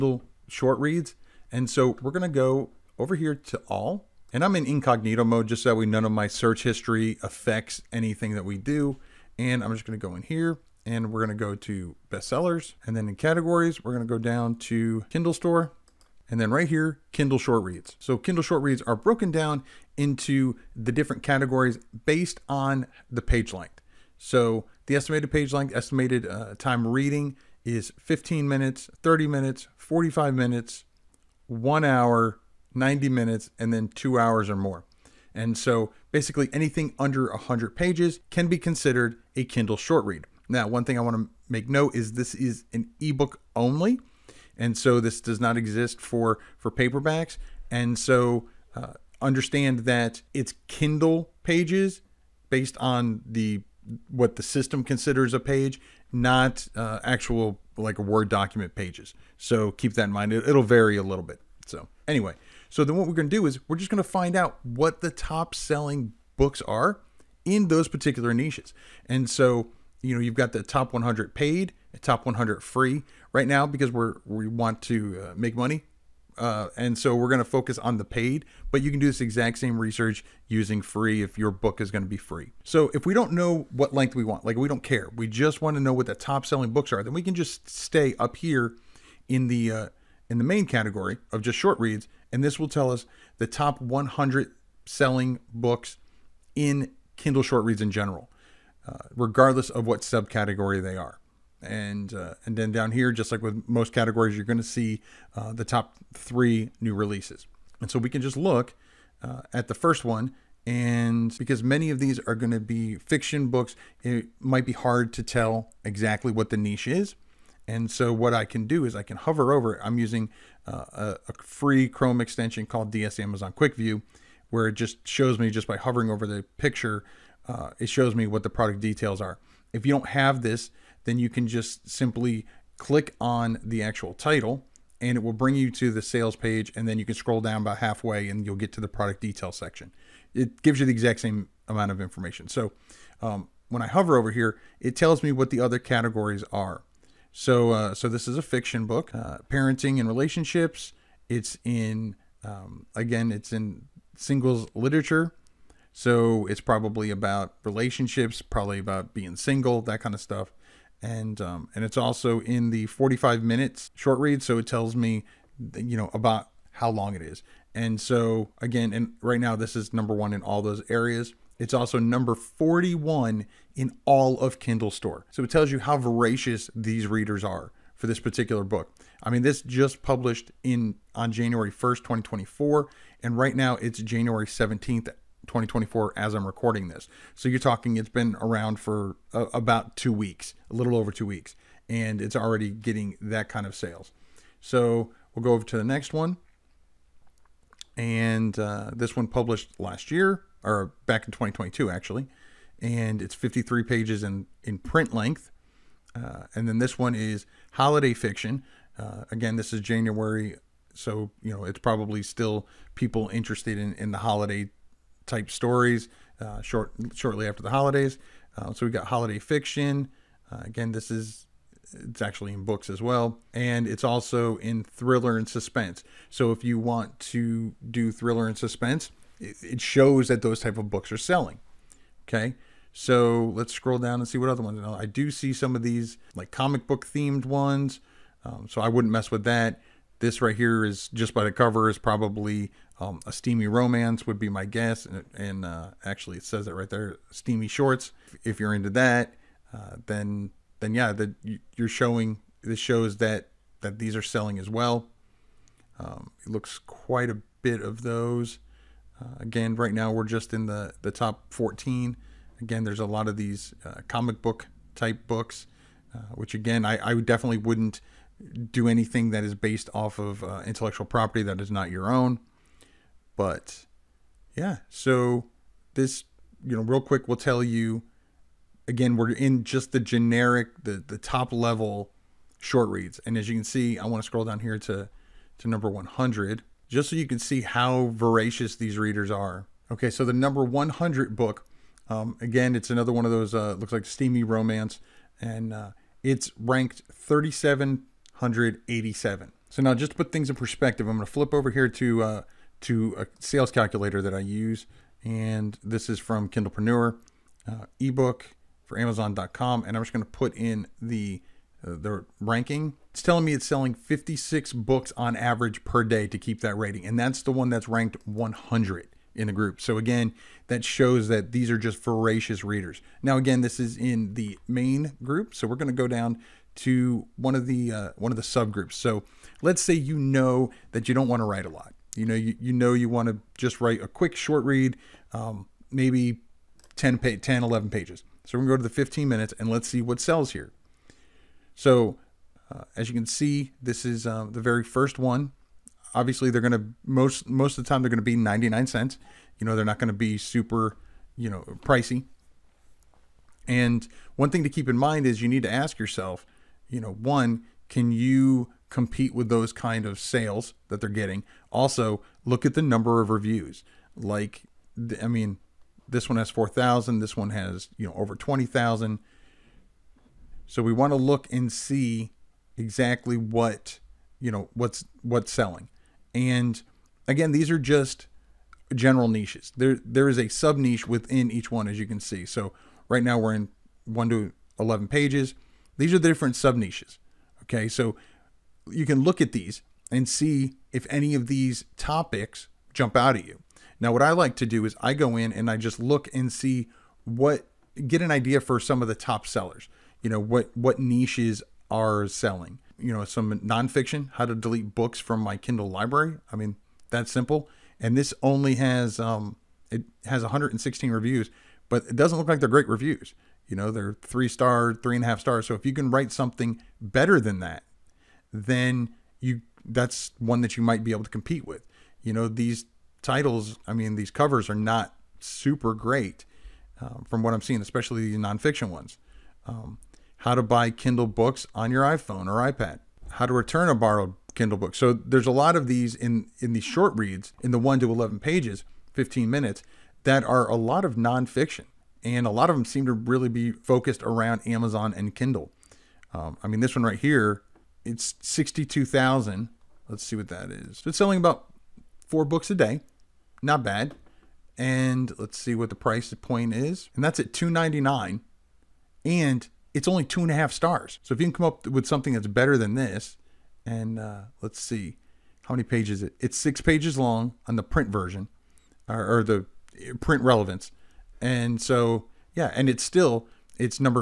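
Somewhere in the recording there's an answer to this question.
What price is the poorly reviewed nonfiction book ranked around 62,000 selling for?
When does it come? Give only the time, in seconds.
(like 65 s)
457 s.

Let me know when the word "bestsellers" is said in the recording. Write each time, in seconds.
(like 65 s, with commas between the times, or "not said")
12 s.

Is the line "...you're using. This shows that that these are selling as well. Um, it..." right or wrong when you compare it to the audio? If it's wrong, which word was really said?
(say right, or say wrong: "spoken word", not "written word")
wrong: "showing", not "using".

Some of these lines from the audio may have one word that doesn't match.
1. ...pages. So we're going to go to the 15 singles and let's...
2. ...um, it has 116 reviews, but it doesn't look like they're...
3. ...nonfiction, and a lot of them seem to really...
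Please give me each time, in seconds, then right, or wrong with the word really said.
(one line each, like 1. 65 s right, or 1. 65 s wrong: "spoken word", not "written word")
1. 337 s wrong: "minutes", not "singles"
2. 409 s right
3. 441 s right.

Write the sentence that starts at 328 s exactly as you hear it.
So let's say you know that you don't want to write a lot.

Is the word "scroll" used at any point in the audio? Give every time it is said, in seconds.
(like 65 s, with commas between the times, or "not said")
137 s, 233 s, 284 s.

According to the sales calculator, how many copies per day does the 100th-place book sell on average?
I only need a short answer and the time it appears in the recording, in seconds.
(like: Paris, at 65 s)
56, at 313 s.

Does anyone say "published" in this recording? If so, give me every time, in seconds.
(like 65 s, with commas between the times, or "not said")
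180 s, 199 s.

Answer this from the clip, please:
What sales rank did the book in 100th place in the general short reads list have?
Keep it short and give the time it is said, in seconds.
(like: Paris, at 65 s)
3,787, at 297 s.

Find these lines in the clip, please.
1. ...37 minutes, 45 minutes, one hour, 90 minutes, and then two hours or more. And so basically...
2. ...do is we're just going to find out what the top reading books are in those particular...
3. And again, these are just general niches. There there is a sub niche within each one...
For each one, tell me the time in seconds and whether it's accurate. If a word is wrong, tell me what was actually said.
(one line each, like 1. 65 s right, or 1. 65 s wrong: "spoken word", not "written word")
1. 29 s wrong: "30", not "37"
2. 63 s wrong: "selling", not "reading"
3. 376 s right.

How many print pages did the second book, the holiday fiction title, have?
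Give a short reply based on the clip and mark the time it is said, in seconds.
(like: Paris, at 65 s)
53, at 203 s.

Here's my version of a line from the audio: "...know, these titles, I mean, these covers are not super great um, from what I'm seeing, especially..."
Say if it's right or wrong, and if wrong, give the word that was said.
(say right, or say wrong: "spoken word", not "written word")
right.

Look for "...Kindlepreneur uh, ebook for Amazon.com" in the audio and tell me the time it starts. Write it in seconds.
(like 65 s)
306 s.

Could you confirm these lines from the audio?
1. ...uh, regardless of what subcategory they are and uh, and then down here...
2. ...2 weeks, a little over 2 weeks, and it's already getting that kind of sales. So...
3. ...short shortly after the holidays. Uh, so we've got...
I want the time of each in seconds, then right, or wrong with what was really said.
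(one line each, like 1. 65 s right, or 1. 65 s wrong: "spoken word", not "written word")
1. 98 s right
2. 189 s right
3. 216 s right.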